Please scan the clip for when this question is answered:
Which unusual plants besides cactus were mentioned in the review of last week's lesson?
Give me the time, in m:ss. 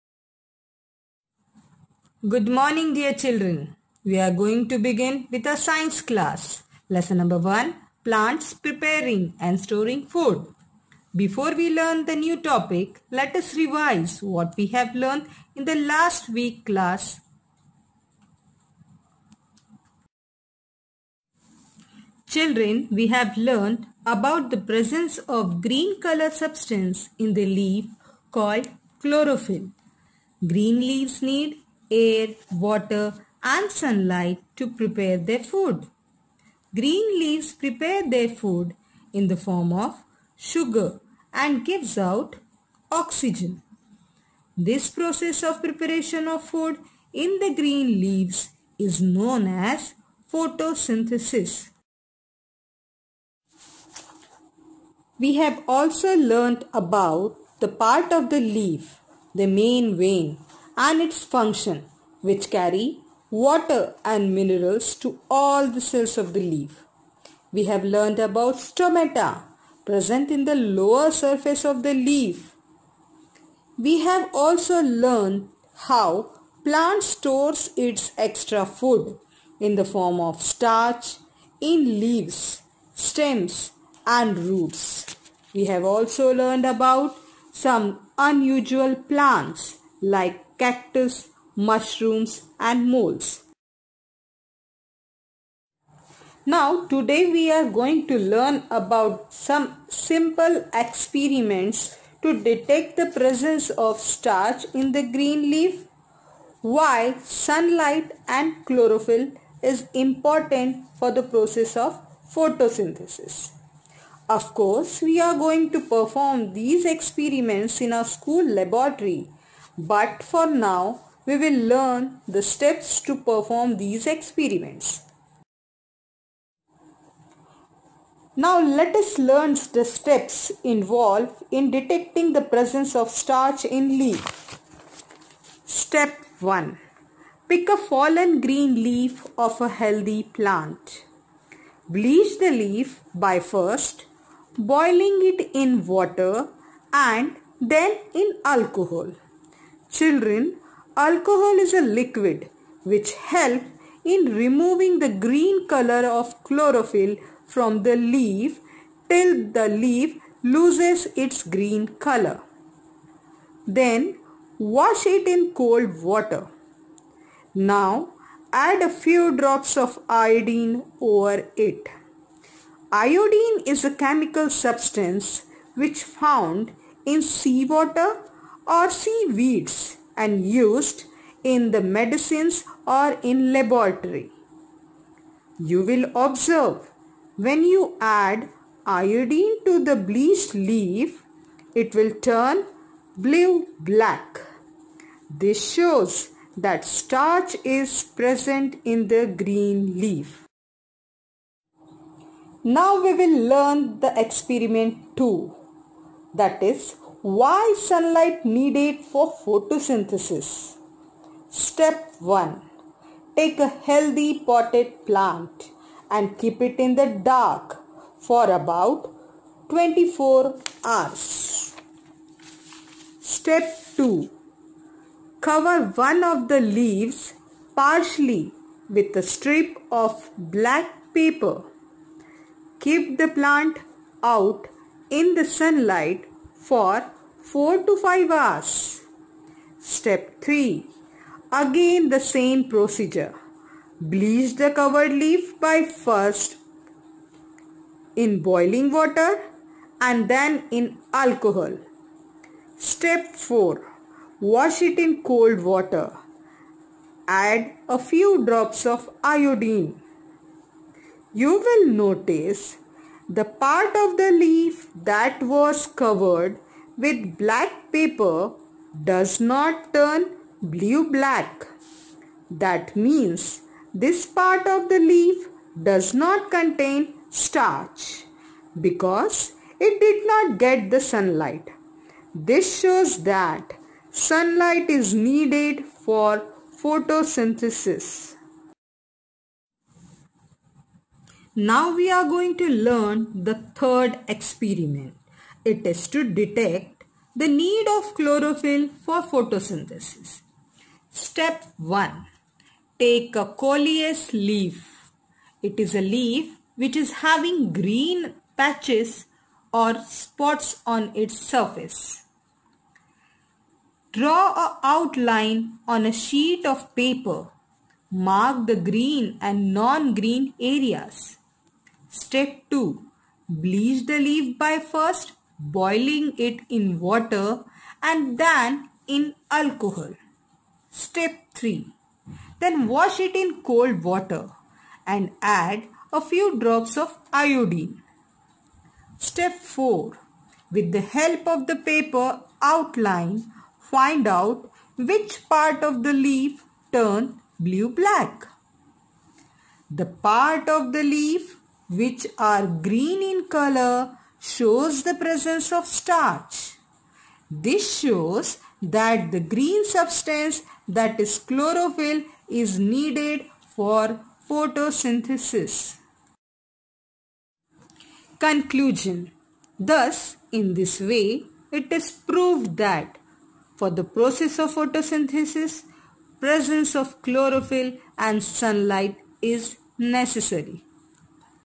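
1:31.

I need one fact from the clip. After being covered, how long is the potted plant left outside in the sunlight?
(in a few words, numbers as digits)
4 to 5 hours.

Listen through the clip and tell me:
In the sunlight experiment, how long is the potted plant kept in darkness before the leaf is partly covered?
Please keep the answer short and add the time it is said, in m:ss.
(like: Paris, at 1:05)
24 hours, at 3:39.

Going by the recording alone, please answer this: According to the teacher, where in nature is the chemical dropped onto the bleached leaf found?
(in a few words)
seawater or seaweeds.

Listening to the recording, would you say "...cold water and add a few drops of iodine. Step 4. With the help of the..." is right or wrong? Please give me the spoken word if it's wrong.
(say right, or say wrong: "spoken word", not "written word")
right.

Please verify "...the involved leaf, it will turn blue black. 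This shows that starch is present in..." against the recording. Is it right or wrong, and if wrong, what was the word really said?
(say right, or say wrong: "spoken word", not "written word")
wrong: "bleached", not "involved".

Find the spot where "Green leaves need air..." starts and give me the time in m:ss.
0:30.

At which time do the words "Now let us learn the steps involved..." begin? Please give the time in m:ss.
2:08.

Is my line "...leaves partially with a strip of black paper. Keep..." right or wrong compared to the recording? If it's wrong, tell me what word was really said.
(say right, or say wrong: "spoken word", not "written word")
right.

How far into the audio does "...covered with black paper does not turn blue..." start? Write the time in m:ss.
4:25.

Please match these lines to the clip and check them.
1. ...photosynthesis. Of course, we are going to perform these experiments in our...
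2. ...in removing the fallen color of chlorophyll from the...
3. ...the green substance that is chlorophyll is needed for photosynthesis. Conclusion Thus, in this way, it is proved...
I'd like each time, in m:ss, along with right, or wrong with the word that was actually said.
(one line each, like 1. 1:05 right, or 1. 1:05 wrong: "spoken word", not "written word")
1. 1:52 right
2. 2:34 wrong: "green", not "fallen"
3. 5:59 right.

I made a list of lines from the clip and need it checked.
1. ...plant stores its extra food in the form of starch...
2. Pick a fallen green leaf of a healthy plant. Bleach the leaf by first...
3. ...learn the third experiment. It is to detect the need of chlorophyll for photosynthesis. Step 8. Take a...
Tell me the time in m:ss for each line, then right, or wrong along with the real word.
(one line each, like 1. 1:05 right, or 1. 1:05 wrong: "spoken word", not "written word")
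1. 1:16 right
2. 2:17 right
3. 4:52 wrong: "1", not "8".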